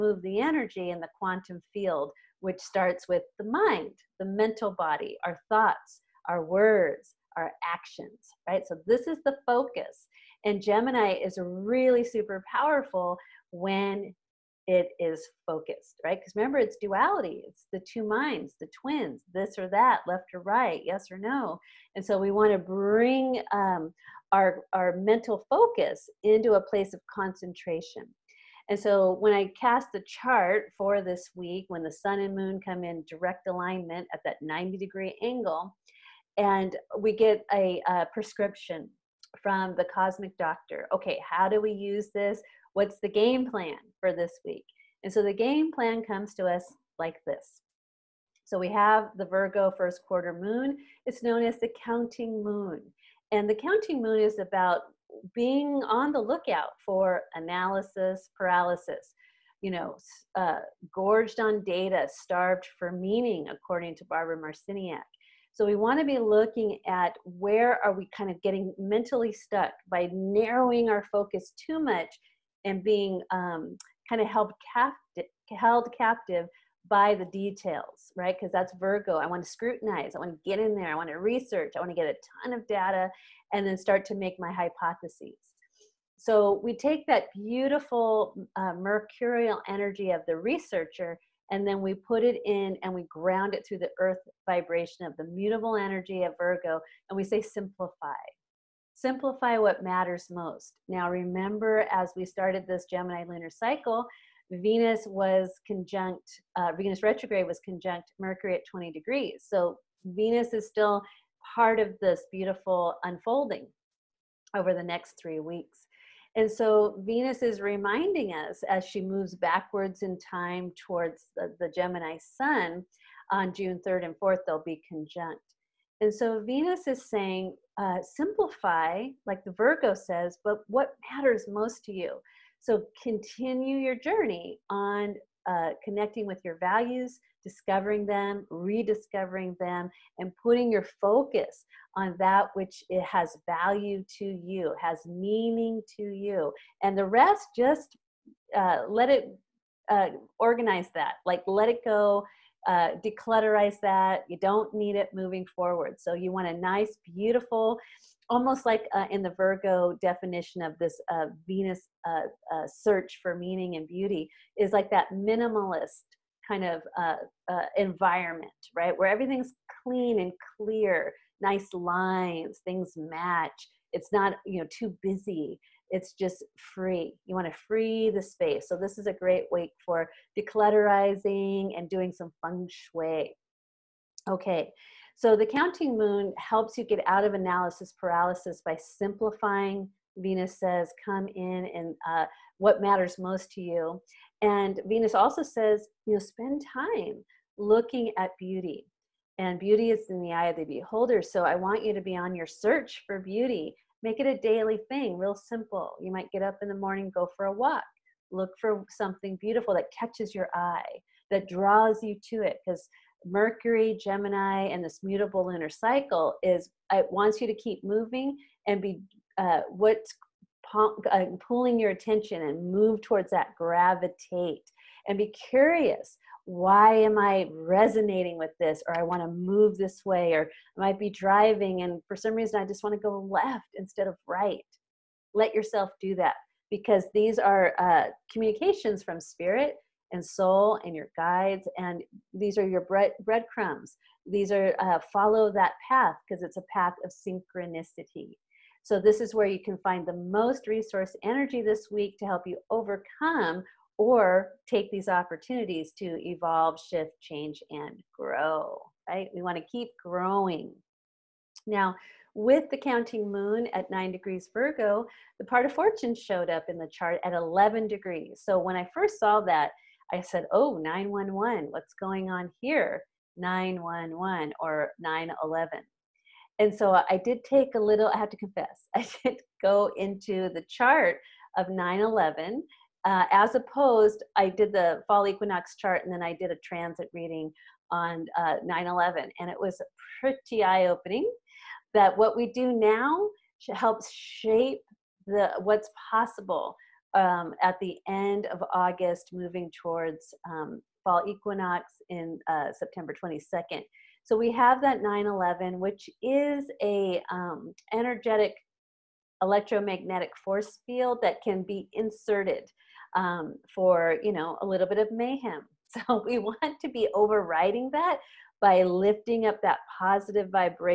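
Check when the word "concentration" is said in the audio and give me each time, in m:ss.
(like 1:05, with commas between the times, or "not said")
0:27.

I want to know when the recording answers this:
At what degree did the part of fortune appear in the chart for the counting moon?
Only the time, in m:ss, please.
4:27.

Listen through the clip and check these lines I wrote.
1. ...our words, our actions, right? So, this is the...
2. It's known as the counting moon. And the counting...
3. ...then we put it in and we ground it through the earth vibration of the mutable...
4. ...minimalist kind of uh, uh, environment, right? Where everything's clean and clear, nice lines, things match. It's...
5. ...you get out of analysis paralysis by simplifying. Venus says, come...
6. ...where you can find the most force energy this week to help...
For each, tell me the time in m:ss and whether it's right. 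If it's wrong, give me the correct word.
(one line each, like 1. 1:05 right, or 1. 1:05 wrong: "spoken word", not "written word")
1. 0:06 right
2. 0:51 right
3. 1:31 right
4. 2:45 right
5. 3:06 right
6. 4:09 wrong: "resource", not "force".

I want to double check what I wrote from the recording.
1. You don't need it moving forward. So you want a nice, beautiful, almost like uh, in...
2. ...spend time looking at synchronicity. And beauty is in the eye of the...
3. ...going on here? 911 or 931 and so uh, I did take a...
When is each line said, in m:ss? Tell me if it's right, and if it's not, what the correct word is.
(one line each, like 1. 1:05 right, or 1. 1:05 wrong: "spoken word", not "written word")
1. 2:34 right
2. 3:16 wrong: "beauty", not "synchronicity"
3. 4:31 wrong: "911", not "931".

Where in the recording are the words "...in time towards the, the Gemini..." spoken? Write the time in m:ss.
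2:00.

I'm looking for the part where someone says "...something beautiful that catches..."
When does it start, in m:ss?
3:28.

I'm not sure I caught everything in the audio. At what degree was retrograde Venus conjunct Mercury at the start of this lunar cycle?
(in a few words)
20 degrees.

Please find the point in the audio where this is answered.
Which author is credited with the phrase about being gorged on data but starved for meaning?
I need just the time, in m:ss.
1:04.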